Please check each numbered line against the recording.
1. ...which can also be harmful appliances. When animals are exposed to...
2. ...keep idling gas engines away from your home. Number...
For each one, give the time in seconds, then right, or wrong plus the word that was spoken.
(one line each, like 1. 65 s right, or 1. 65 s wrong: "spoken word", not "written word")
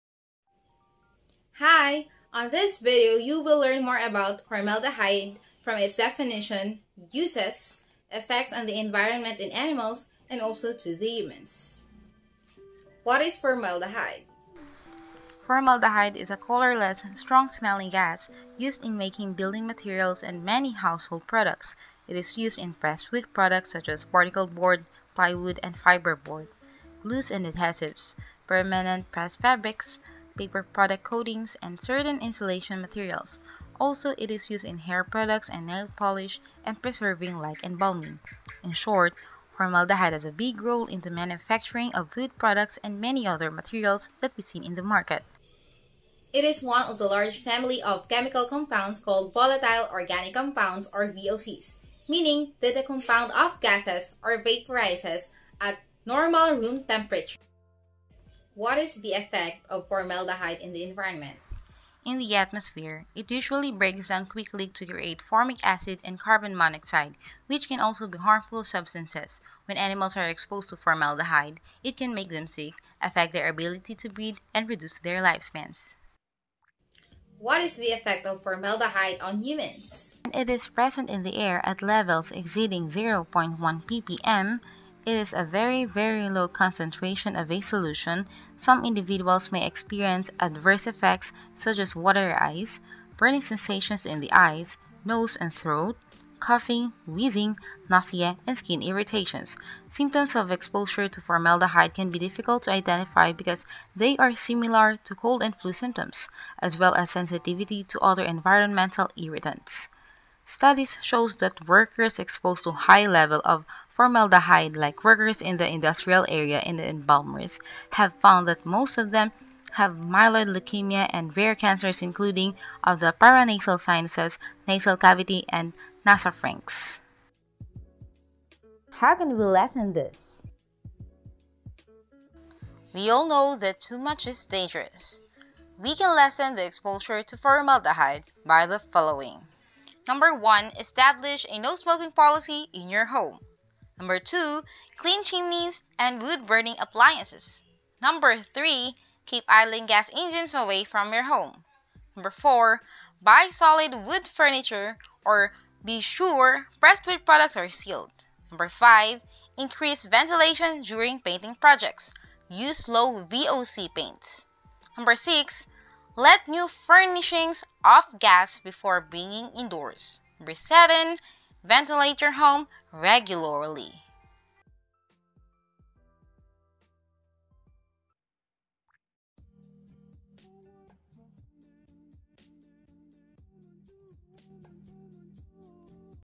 1. 67 s wrong: "substances", not "appliances"
2. 149 s right.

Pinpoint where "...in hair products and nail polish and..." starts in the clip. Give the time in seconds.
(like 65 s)
34 s.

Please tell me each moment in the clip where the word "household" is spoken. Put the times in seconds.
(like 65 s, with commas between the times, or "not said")
20 s.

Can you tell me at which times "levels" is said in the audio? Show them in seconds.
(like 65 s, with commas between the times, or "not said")
81 s, 113 s.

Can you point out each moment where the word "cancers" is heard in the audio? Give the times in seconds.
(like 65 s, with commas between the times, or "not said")
121 s.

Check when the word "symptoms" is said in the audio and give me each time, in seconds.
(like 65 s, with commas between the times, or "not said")
99 s, 105 s.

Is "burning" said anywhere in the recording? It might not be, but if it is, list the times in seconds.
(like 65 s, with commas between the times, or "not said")
93 s, 146 s.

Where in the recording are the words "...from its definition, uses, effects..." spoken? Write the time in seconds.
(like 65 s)
5 s.